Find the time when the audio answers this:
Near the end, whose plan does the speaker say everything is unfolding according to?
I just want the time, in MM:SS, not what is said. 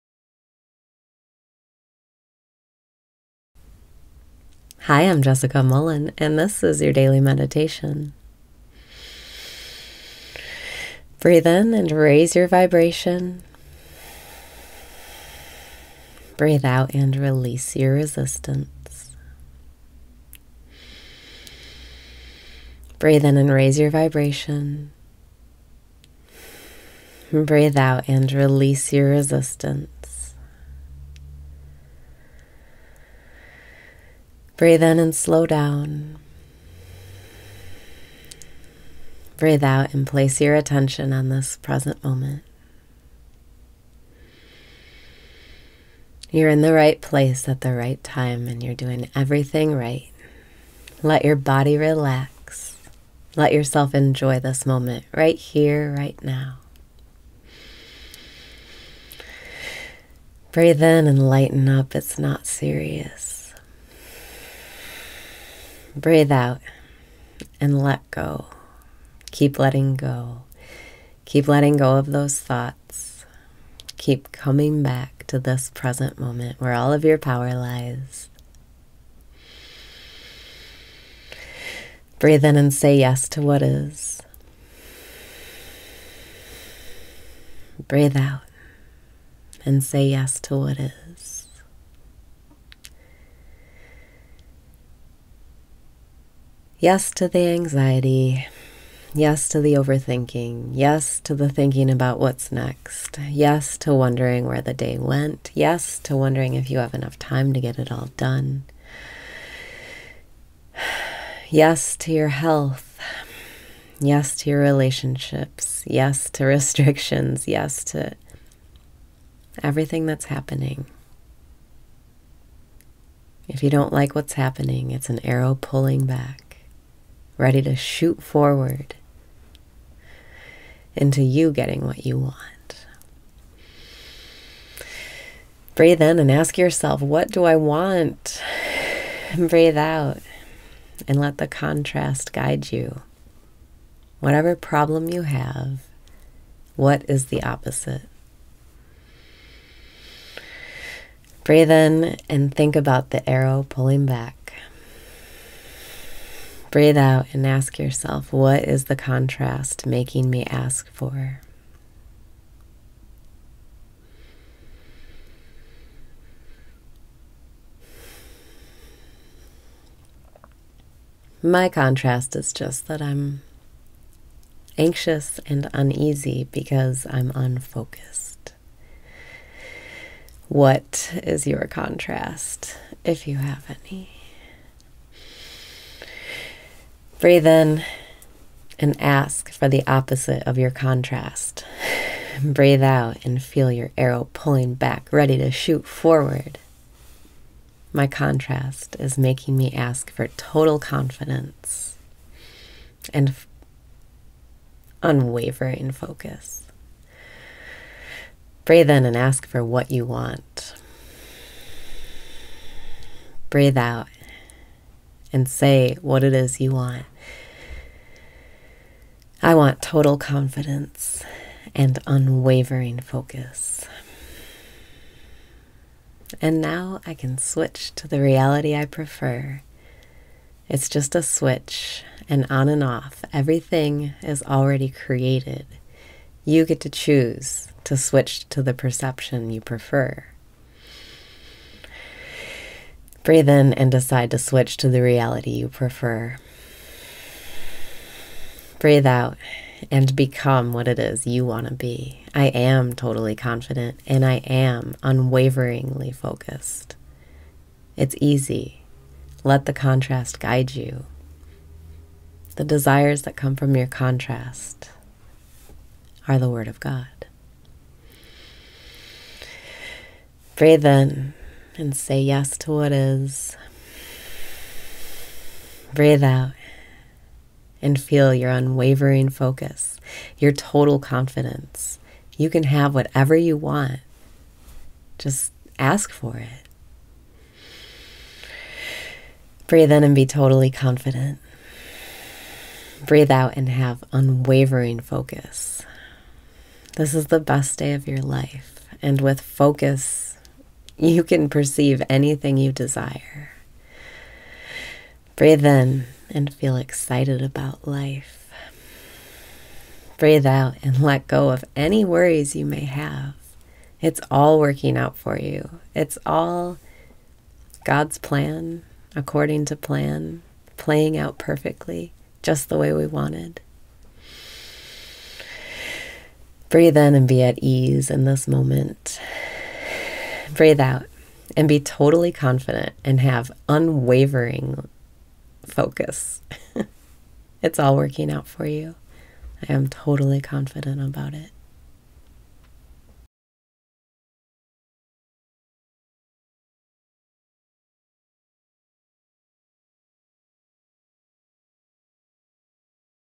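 05:17.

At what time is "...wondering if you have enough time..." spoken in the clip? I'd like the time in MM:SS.
01:46.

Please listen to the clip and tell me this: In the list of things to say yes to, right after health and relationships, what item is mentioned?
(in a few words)
restrictions.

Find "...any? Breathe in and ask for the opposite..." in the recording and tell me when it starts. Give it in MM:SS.
03:03.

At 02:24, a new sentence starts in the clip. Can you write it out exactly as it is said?
Whatever problem you have, what is the opposite?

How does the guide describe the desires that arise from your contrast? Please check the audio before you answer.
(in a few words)
The Word of God.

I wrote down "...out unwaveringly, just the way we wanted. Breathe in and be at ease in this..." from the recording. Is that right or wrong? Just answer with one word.
wrong.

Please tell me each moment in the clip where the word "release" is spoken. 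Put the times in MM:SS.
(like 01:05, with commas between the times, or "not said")
00:17, 00:28.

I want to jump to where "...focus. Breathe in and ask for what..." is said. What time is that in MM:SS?
03:25.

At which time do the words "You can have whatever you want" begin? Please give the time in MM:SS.
04:42.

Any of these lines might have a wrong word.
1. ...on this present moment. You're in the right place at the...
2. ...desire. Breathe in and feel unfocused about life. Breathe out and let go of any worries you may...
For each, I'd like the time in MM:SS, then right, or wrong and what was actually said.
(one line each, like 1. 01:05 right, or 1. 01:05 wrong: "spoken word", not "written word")
1. 00:41 right
2. 05:02 wrong: "excited", not "unfocused".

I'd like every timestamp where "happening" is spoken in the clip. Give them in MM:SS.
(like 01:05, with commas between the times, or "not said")
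02:00, 02:04.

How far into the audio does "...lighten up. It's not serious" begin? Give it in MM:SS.
01:01.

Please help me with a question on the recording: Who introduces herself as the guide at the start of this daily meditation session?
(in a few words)
Jessica Mullen.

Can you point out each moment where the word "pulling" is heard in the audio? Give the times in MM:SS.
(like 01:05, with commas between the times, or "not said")
02:05, 02:33, 03:14.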